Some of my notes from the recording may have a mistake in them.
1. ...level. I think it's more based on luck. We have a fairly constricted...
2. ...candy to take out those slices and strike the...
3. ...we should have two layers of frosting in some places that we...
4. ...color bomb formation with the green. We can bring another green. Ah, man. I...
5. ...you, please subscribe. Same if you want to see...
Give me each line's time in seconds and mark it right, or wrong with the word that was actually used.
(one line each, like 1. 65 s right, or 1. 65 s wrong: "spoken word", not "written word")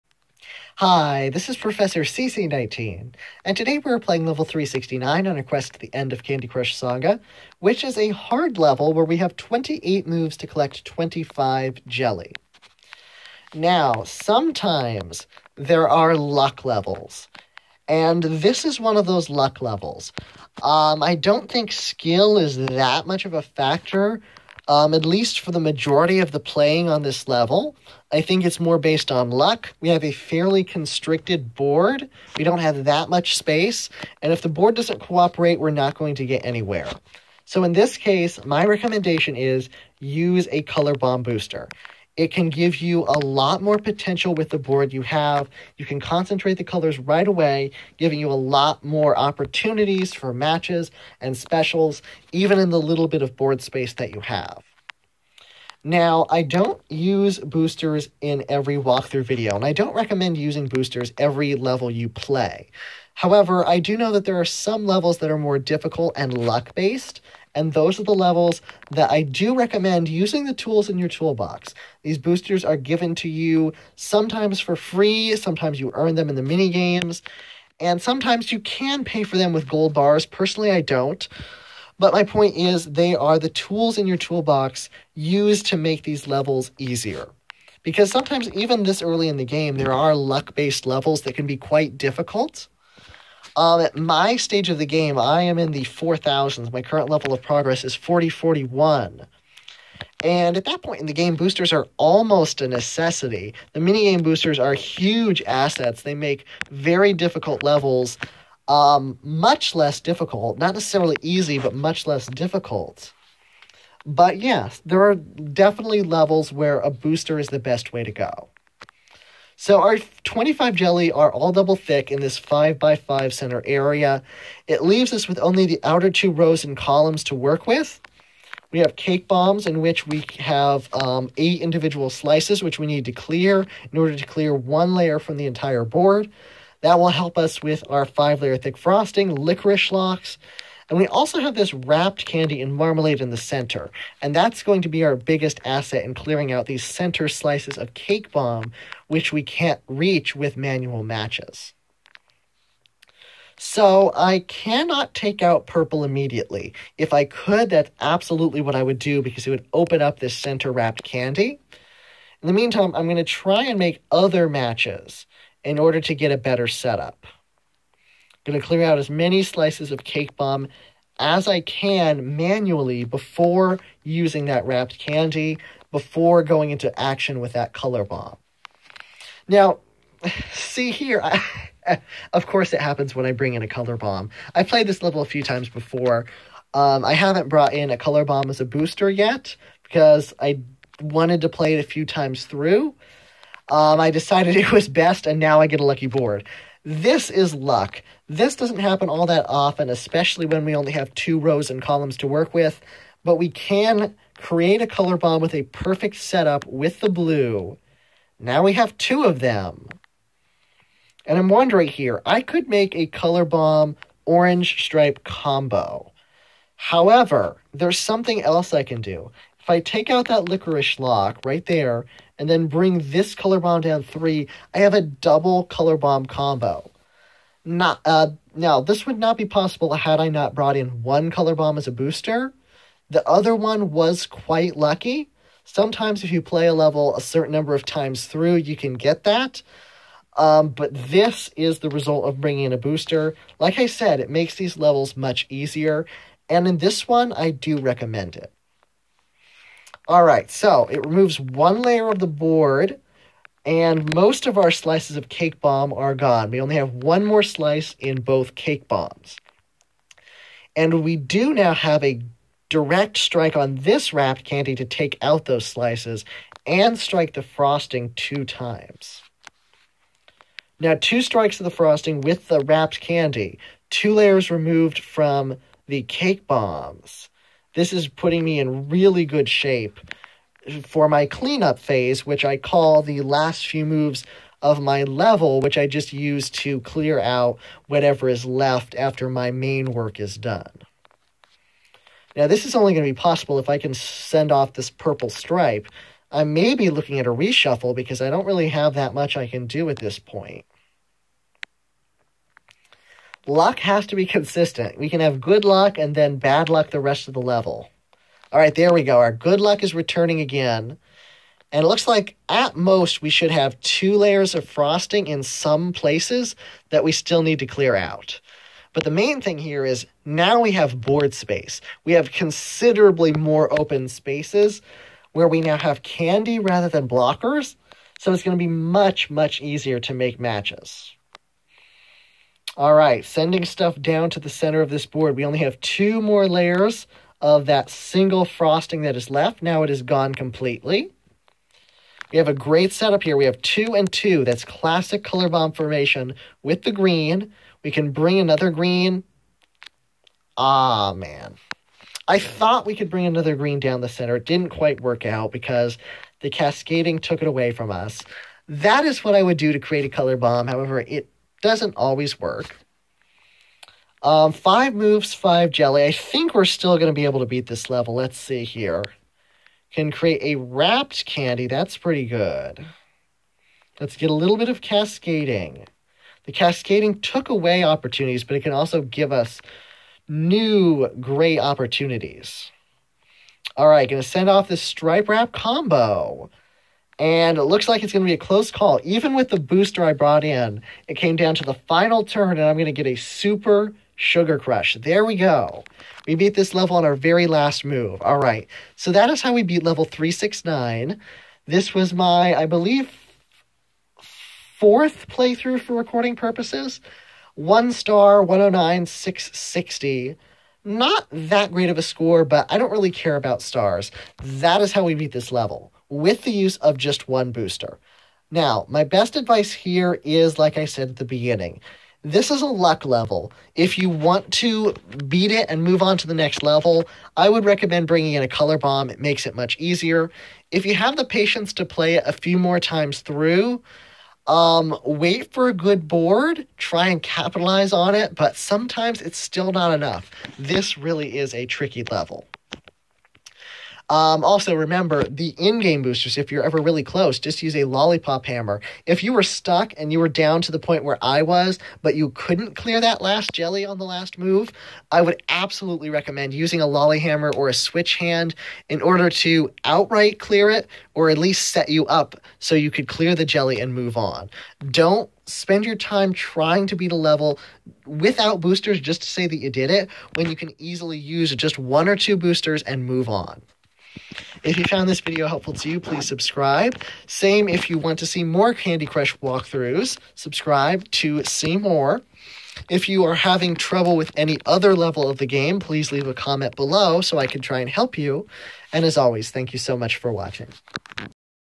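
1. 27 s right
2. 264 s right
3. 313 s right
4. 345 s right
5. 475 s right.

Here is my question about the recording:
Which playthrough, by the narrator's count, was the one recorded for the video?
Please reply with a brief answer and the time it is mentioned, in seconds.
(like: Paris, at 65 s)
fourth, at 404 s.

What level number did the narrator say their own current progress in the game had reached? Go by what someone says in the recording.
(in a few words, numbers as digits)
4041.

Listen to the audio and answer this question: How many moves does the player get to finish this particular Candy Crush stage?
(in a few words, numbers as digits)
28.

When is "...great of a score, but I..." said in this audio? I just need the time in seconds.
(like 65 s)
411 s.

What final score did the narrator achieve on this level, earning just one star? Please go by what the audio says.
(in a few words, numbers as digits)
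109,660.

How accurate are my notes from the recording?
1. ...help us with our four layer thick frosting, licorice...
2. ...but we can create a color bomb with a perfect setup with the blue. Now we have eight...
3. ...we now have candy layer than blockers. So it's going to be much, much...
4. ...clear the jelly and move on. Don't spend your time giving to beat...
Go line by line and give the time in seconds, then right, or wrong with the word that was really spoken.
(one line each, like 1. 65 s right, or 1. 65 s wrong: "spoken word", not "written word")
1. 137 s wrong: "five", not "four"
2. 203 s wrong: "two", not "eight"
3. 325 s wrong: "rather", not "layer"
4. 463 s wrong: "trying", not "giving".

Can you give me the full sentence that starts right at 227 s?
Not uh, now, this would not be possible had I not brought in one color bomb as a booster.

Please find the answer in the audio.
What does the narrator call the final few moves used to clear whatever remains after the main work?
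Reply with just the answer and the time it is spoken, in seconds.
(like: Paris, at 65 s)
cleanup phase, at 281 s.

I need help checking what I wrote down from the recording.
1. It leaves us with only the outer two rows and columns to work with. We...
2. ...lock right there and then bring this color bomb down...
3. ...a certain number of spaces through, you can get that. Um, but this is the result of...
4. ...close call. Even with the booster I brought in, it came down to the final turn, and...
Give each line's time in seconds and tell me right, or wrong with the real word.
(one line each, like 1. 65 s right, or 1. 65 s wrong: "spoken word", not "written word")
1. 124 s right
2. 221 s right
3. 237 s wrong: "times", not "spaces"
4. 388 s right.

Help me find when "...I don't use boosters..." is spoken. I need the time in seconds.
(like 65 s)
56 s.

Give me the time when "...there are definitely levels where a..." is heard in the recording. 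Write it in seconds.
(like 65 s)
114 s.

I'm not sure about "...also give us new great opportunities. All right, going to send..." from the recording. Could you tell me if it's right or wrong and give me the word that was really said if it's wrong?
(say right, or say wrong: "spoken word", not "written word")
right.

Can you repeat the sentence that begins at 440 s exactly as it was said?
This really is a tricky level.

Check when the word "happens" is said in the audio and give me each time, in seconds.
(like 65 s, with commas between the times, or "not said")
182 s, 198 s.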